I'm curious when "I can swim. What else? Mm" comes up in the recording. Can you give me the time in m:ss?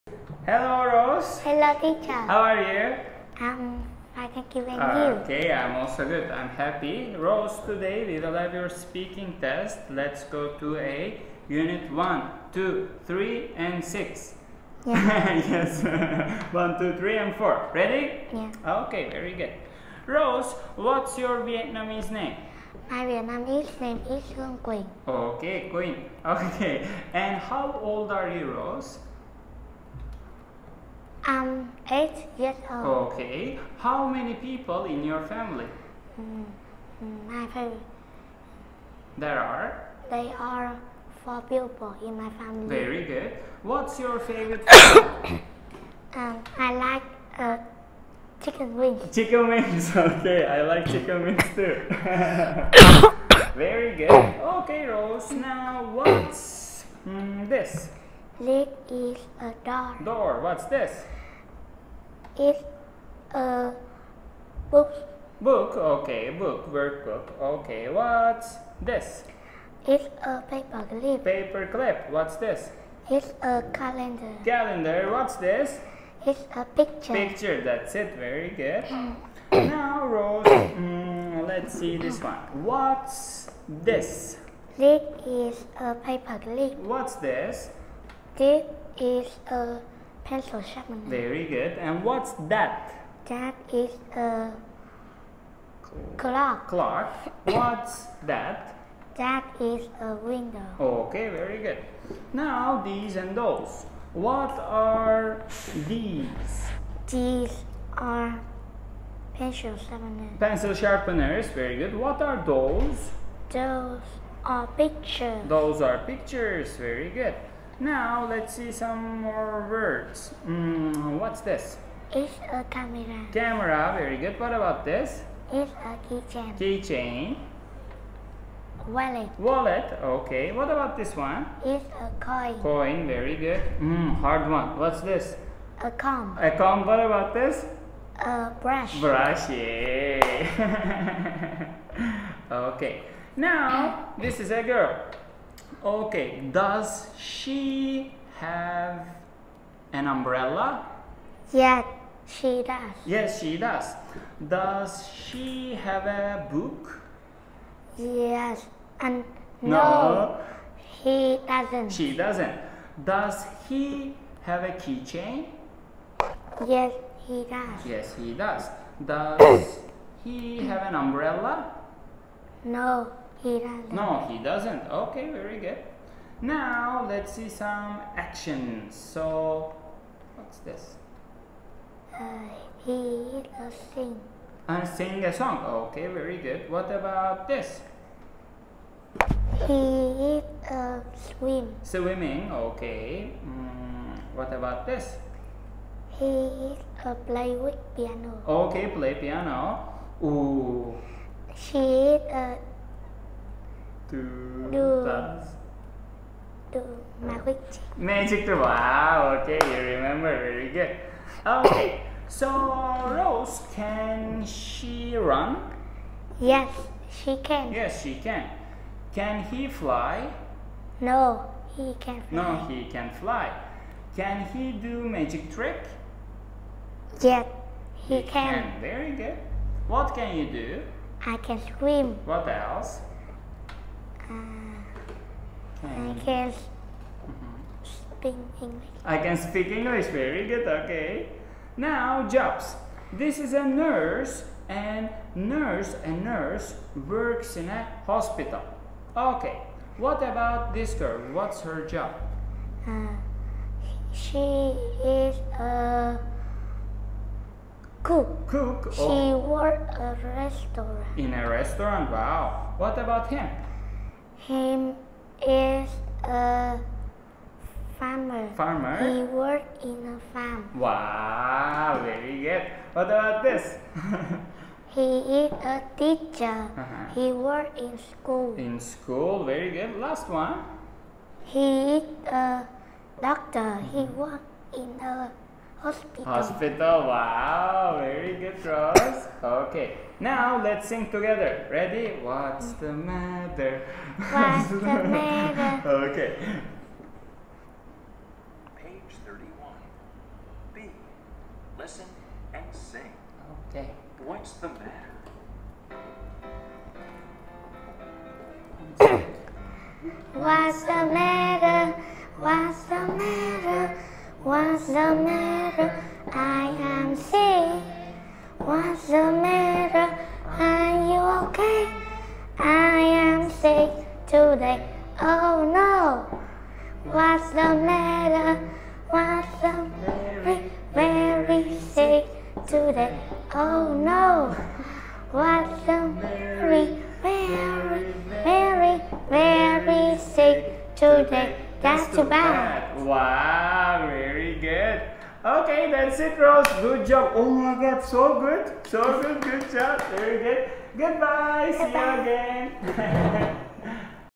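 3:51.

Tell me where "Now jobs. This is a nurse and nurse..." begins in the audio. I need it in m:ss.
4:01.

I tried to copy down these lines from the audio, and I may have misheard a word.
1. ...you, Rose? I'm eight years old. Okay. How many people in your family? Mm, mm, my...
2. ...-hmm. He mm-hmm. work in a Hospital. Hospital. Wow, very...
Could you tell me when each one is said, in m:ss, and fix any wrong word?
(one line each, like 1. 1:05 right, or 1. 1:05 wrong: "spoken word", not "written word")
1. 0:28 right
2. 4:43 right.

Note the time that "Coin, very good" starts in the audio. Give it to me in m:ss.
2:12.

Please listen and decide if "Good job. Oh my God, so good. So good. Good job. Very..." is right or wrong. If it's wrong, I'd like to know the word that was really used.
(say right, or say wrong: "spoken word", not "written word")
right.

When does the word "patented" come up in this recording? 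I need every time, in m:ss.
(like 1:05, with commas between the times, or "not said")
not said.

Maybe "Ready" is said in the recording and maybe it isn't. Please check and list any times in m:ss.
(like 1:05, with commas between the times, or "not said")
0:17, 4:51.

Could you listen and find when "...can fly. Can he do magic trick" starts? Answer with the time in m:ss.
3:42.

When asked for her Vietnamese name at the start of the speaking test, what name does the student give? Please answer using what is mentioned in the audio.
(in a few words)
Hương Quỳnh.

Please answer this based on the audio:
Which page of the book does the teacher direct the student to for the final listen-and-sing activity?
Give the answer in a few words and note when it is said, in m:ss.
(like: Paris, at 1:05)
31, at 4:58.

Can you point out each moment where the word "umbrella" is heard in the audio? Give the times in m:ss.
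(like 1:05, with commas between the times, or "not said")
2:30, 2:50.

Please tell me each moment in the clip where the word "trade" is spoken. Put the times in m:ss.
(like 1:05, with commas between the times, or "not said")
not said.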